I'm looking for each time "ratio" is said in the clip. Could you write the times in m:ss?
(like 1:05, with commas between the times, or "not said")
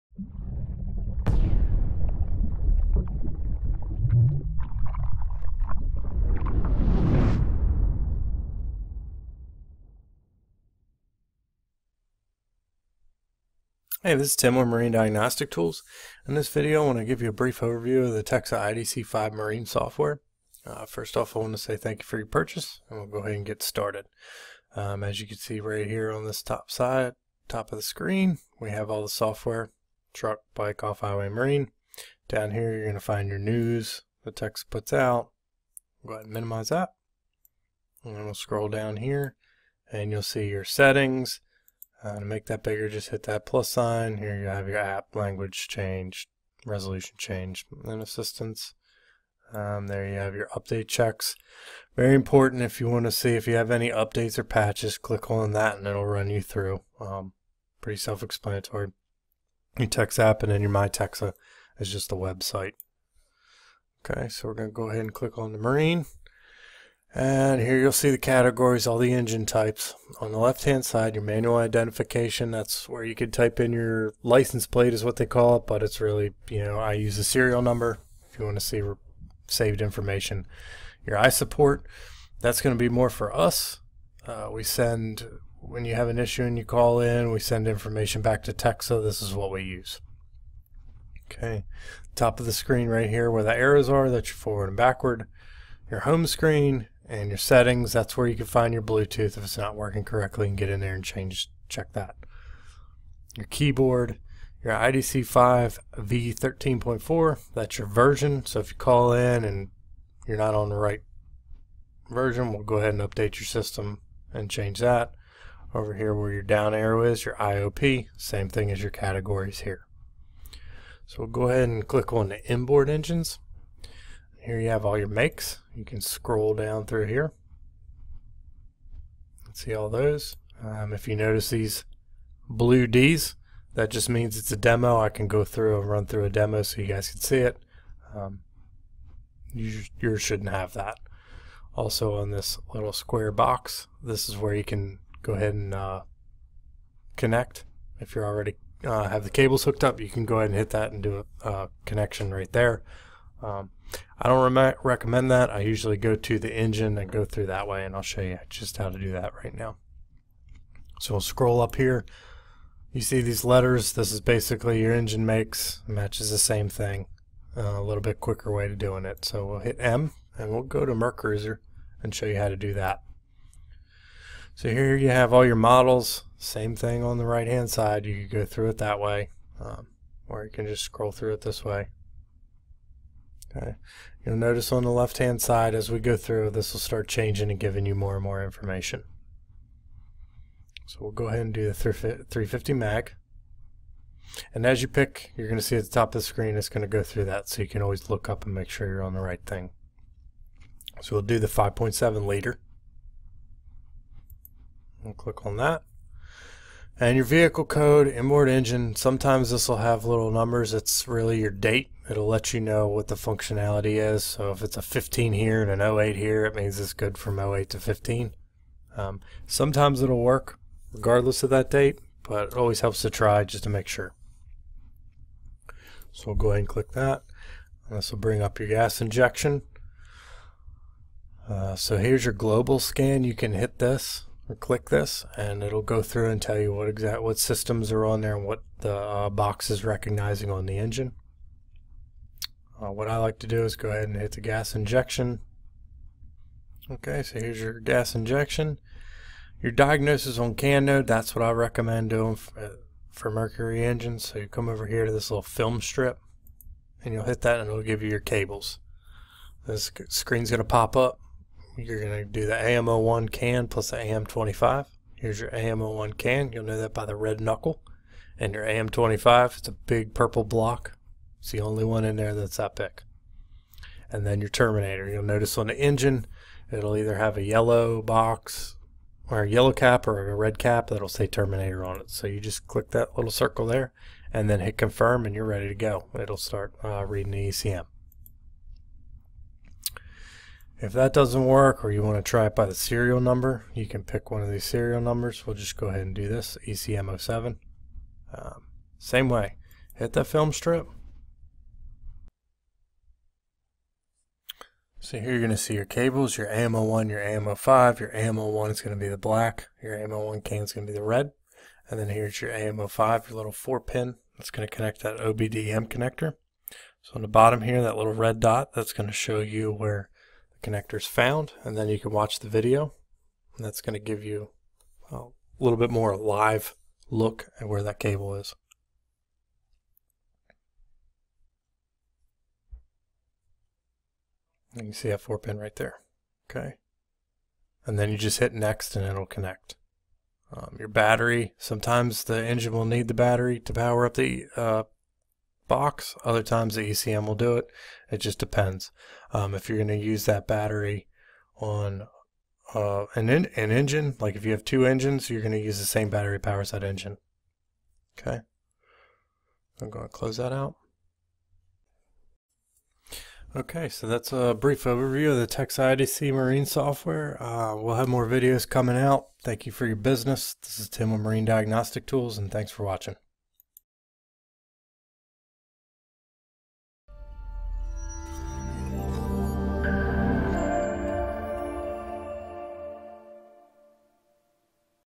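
not said.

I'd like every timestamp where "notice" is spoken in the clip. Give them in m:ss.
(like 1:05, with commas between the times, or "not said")
2:11, 3:04, 4:35.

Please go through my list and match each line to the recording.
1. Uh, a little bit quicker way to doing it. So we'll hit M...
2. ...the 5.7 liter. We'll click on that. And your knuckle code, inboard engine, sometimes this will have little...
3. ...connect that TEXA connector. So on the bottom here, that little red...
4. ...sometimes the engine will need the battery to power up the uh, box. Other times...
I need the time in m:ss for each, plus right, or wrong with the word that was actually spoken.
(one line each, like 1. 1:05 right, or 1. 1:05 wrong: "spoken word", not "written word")
1. 2:47 right
2. 3:21 wrong: "vehicle", not "knuckle"
3. 5:14 wrong: "OBDM", not "TEXA"
4. 5:41 right.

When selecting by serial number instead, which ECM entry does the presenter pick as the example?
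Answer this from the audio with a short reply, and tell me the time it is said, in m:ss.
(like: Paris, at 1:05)
ECM07, at 4:56.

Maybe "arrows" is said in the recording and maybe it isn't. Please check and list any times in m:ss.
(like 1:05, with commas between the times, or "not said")
1:33, 1:56.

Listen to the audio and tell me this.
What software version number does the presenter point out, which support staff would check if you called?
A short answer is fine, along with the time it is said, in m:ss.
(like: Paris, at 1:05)
V13.4, at 1:45.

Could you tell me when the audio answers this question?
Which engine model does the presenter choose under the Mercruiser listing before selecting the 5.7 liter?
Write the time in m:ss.
3:11.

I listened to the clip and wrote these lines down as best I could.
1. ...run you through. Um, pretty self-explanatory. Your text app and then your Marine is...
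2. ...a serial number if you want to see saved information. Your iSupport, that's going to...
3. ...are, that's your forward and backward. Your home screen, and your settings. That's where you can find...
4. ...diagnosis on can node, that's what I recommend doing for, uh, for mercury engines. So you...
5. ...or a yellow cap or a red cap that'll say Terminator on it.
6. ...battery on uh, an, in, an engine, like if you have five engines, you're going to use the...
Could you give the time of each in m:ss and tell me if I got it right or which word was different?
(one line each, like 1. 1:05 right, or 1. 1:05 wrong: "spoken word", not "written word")
1. 0:56 wrong: "MyTexa", not "Marine"
2. 1:17 right
3. 1:33 right
4. 4:09 right
5. 4:39 right
6. 5:50 wrong: "two", not "five".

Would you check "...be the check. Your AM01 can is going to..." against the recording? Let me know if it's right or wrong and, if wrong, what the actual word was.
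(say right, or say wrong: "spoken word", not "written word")
wrong: "black", not "check".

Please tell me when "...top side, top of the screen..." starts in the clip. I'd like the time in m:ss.
0:26.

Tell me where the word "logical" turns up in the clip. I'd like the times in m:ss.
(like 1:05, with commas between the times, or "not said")
not said.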